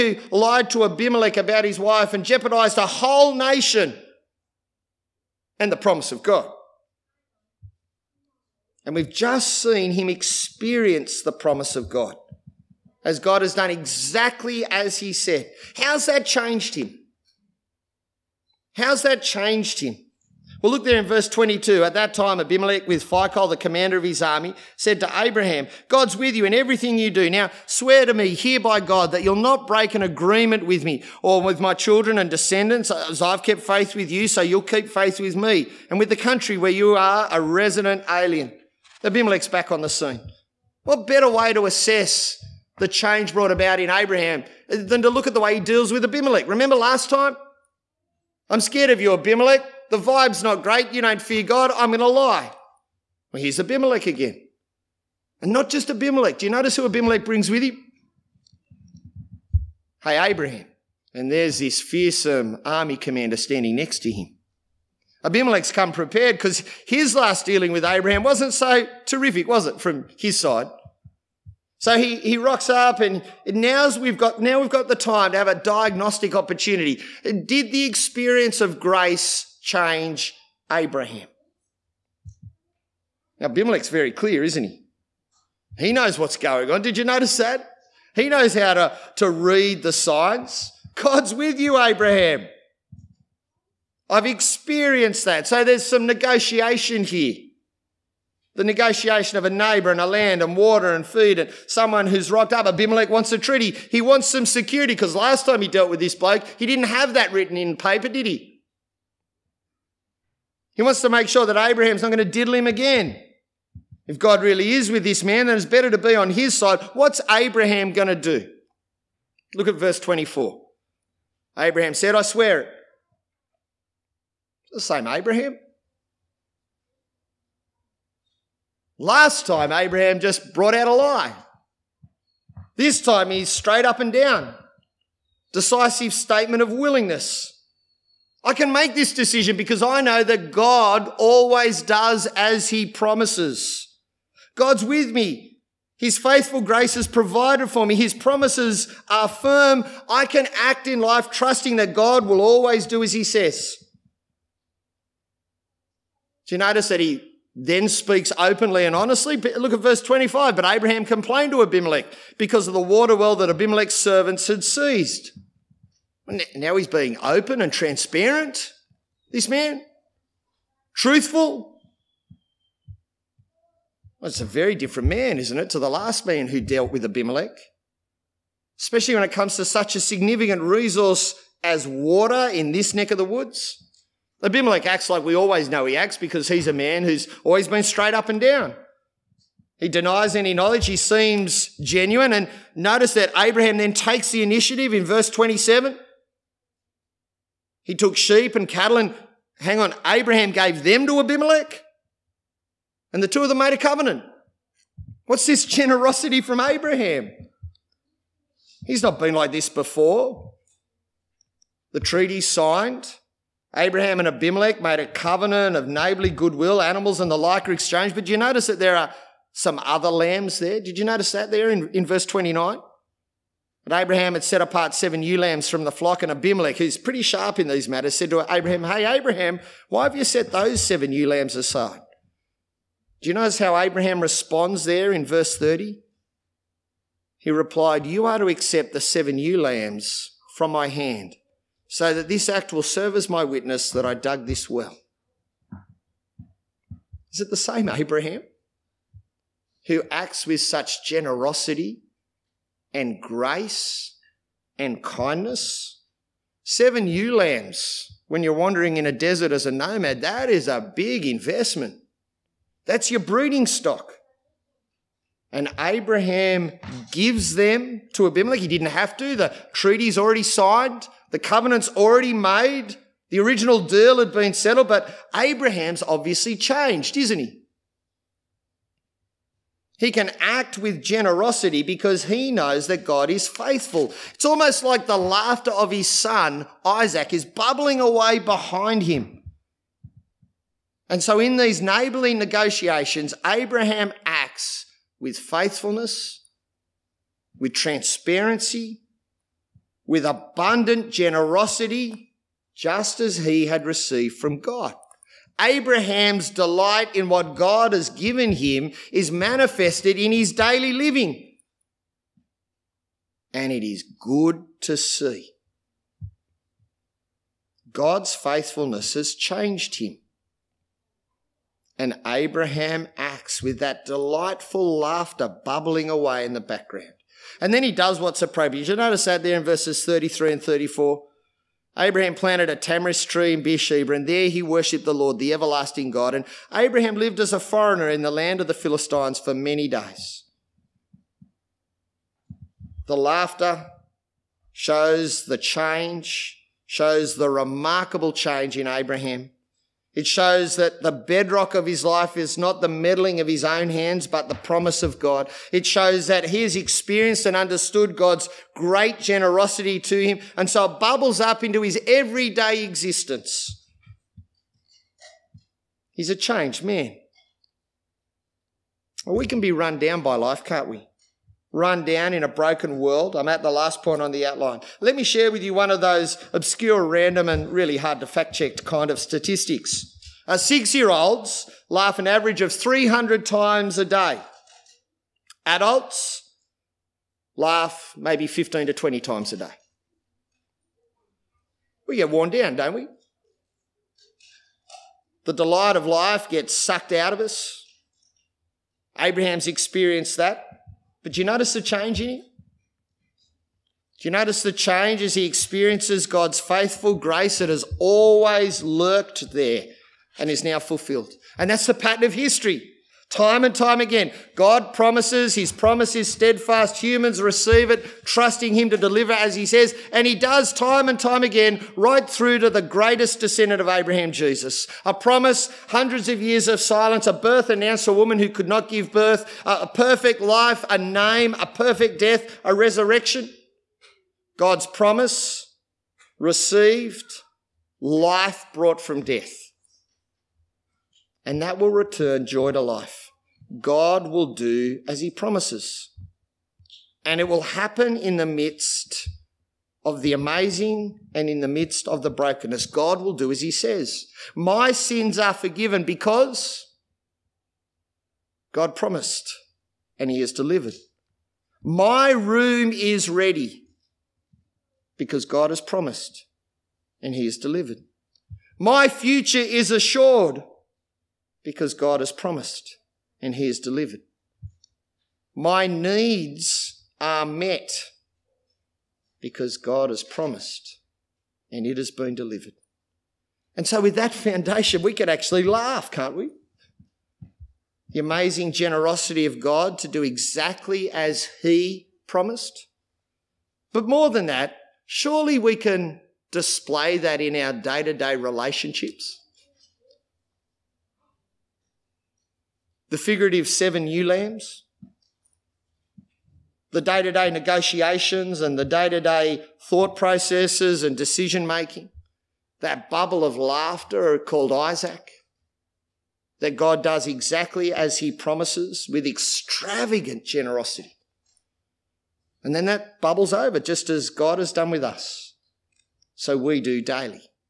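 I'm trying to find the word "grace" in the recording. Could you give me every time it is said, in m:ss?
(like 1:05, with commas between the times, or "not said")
1:18, 2:26, 4:13, 6:47.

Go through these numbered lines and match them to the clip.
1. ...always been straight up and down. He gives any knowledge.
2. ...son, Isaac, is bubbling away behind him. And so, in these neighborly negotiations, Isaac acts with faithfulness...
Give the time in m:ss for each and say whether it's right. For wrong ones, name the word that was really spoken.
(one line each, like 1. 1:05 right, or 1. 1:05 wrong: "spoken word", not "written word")
1. 3:07 wrong: "denies", not "gives"
2. 4:46 wrong: "Abraham", not "Isaac".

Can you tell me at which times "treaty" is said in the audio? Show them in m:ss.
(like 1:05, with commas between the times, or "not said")
1:43, 3:31, 4:29.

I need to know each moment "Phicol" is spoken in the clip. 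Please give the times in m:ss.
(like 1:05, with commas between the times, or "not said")
0:23.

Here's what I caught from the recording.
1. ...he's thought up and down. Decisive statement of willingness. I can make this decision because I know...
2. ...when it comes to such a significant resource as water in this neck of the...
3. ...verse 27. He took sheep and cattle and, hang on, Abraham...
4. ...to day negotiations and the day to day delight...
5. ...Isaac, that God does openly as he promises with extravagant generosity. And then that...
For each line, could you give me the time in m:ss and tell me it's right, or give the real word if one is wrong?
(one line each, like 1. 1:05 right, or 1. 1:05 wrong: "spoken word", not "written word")
1. 2:13 wrong: "straight", not "thought"
2. 2:59 right
3. 3:15 right
4. 8:27 wrong: "thought", not "delight"
5. 8:34 wrong: "exactly", not "openly".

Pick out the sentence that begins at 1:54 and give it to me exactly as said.
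If God really is with this man, then it's better to be on his side.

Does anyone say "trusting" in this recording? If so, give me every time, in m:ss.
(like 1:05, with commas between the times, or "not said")
2:31, 6:58.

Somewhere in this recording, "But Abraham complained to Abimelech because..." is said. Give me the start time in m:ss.
2:40.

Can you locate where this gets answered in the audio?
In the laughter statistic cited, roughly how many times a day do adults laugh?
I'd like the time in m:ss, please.
6:28.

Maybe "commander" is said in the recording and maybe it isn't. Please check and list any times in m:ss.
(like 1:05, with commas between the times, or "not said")
0:23, 1:02.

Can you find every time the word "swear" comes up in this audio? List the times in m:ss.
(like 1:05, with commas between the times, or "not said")
0:27, 2:02.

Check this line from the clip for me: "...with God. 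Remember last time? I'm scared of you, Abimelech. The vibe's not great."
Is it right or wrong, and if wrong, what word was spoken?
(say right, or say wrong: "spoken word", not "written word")
wrong: "Abimelech", not "God".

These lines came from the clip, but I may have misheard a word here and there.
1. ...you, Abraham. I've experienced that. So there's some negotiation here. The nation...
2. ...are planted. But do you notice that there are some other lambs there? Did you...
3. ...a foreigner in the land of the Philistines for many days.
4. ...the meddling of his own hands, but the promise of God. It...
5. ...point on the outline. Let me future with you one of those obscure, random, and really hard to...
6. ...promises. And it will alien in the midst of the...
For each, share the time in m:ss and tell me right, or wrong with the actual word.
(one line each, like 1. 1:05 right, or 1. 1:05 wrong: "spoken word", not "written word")
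1. 1:31 wrong: "negotiation", not "nation"
2. 3:37 wrong: "exchanged", not "planted"
3. 5:37 right
4. 5:52 right
5. 6:14 wrong: "share", not "future"
6. 7:25 wrong: "happen", not "alien".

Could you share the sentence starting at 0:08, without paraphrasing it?
And we've just seen him experience the promise of God as God has done exactly as he said.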